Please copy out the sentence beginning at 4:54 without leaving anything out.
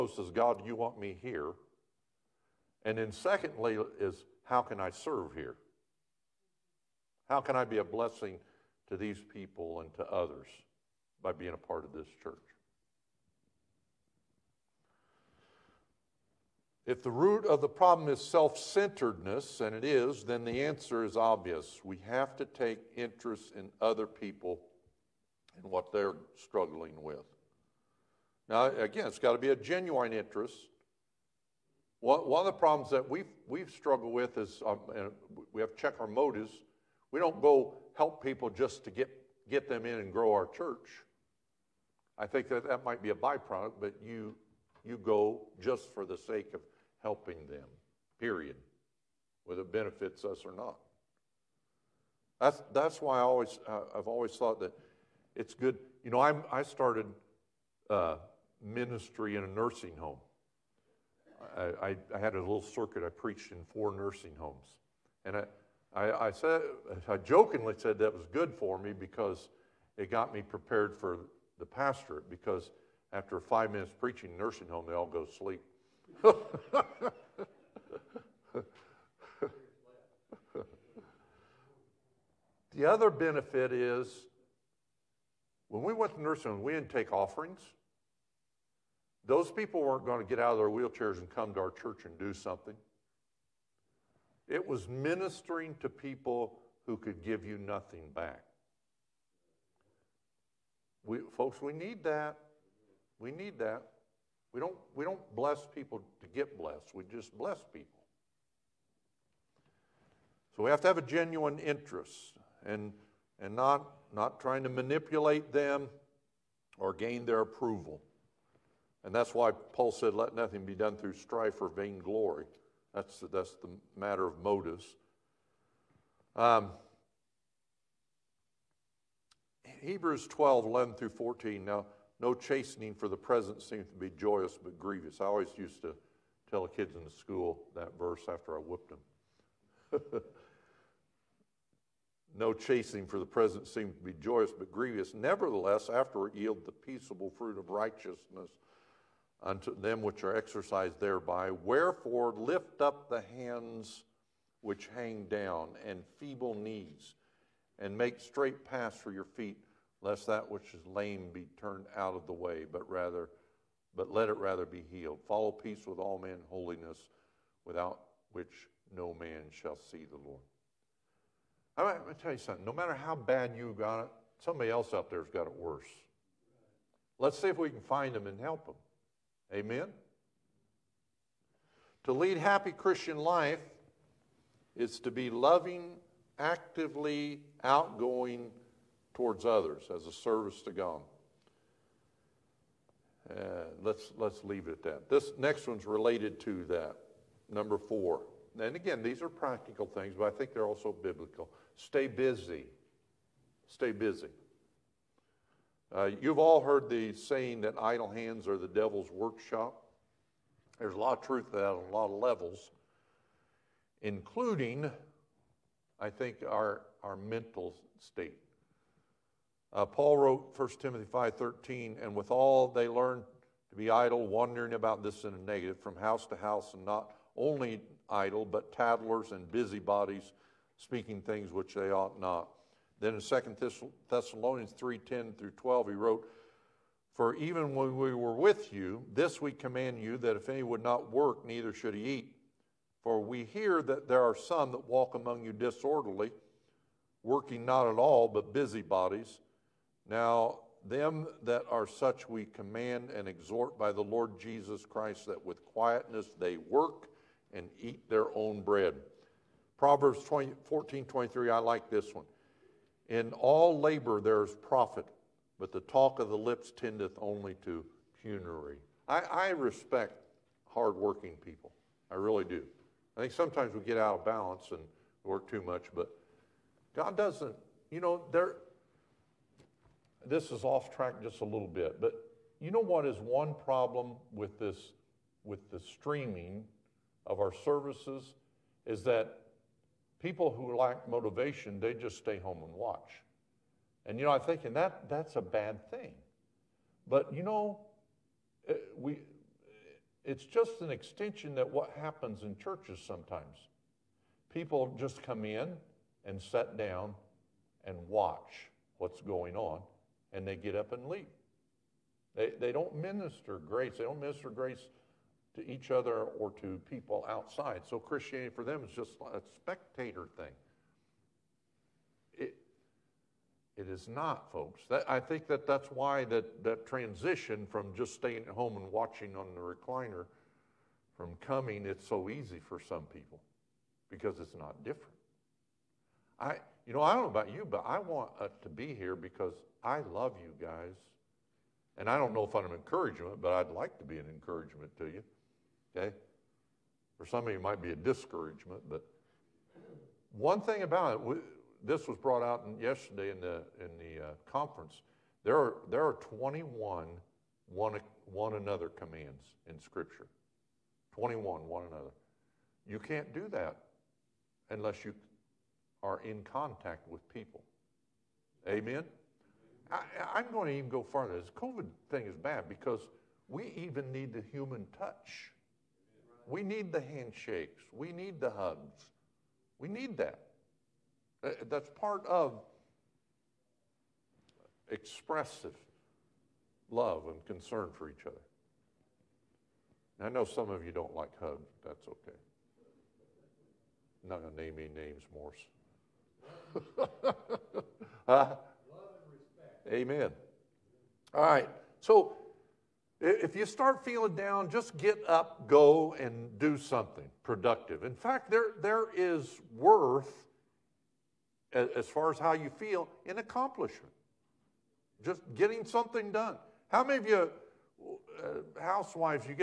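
And you know, I'm thinking that that's a bad thing.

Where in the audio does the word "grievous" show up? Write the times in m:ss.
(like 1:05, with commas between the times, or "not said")
2:14, 2:24.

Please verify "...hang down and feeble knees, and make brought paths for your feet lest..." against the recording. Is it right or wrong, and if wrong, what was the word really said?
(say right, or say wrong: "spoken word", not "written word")
wrong: "straight", not "brought".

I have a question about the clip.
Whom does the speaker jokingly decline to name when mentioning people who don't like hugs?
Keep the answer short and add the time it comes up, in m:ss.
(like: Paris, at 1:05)
Morse, at 6:35.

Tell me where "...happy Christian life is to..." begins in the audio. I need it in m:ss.
3:02.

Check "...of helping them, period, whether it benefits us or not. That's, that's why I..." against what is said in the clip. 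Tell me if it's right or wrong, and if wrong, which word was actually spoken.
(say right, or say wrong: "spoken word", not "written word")
right.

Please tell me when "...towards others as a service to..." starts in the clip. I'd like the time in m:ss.
3:09.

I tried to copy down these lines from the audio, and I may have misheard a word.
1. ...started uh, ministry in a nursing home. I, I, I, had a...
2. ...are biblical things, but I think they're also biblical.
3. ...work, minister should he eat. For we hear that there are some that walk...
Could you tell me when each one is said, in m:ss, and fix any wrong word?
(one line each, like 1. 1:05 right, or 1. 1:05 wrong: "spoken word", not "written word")
1. 0:56 right
2. 3:19 wrong: "practical", not "biblical"
3. 4:01 wrong: "neither", not "minister".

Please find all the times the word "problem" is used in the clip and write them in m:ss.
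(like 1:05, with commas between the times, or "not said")
0:17, 0:32, 4:43.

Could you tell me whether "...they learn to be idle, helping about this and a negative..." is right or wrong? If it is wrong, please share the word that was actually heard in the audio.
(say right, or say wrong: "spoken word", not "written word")
wrong: "wandering", not "helping".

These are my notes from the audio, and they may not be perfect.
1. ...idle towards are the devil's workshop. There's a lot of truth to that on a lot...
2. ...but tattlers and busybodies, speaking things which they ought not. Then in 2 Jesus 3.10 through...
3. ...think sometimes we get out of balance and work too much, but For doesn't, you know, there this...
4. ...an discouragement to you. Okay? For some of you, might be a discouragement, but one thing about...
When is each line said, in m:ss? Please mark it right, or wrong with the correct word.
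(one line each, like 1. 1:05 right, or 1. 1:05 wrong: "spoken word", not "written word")
1. 3:27 wrong: "hands", not "towards"
2. 3:48 wrong: "Thessalonians", not "Jesus"
3. 4:33 wrong: "God", not "For"
4. 5:44 wrong: "encouragement", not "discouragement".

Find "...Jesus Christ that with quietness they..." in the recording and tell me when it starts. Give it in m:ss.
4:14.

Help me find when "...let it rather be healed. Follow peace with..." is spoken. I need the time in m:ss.
2:44.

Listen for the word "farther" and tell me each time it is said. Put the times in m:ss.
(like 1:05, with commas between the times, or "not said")
6:11.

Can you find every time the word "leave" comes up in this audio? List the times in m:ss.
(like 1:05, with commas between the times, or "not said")
3:14, 5:11.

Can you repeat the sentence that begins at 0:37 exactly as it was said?
We don't go help people just to get, get them in and grow our church.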